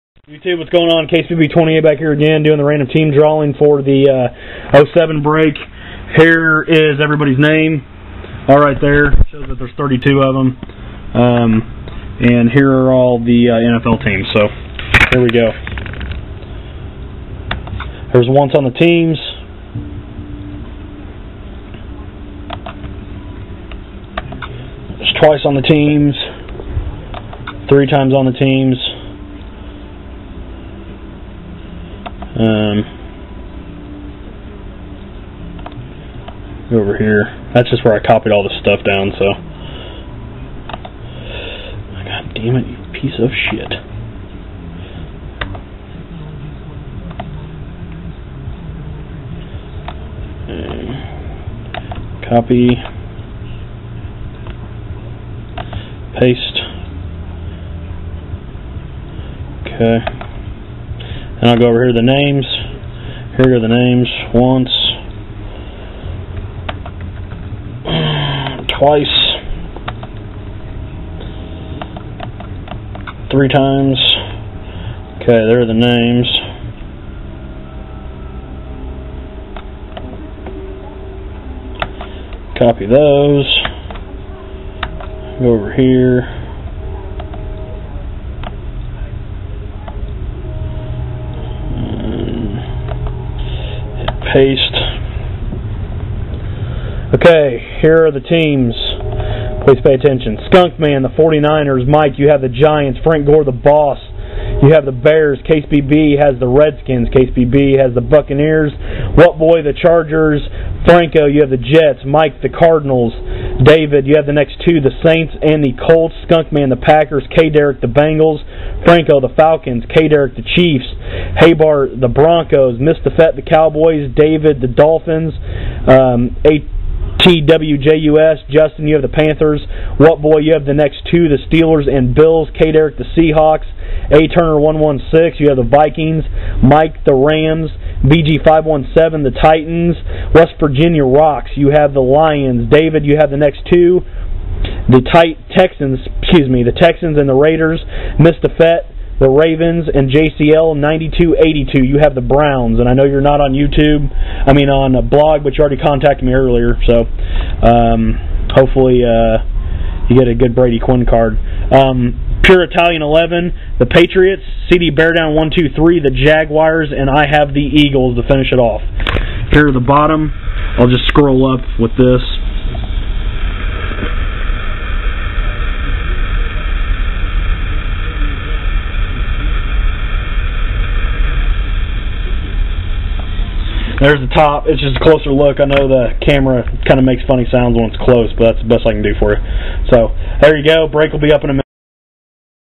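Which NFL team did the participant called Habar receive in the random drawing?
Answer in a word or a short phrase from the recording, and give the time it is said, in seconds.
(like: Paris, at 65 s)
Broncos, at 121 s.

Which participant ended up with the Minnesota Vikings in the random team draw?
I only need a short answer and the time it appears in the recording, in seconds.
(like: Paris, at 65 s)
A. Turner 116, at 134 s.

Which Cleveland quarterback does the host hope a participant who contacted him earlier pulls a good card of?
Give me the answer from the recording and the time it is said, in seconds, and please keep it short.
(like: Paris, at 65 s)
Brady Quinn, at 160 s.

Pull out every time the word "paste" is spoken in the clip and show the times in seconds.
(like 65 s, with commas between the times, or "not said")
56 s, 94 s.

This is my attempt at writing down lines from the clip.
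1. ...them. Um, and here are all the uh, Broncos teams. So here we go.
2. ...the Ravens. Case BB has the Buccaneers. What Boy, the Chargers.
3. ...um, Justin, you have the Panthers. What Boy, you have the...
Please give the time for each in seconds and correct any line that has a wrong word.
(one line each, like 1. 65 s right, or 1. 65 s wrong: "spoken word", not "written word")
1. 10 s wrong: "NFL", not "Broncos"
2. 106 s wrong: "Redskins", not "Ravens"
3. 125 s right.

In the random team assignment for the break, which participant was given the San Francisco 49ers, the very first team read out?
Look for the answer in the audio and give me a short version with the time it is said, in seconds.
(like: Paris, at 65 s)
Skunk Man, at 100 s.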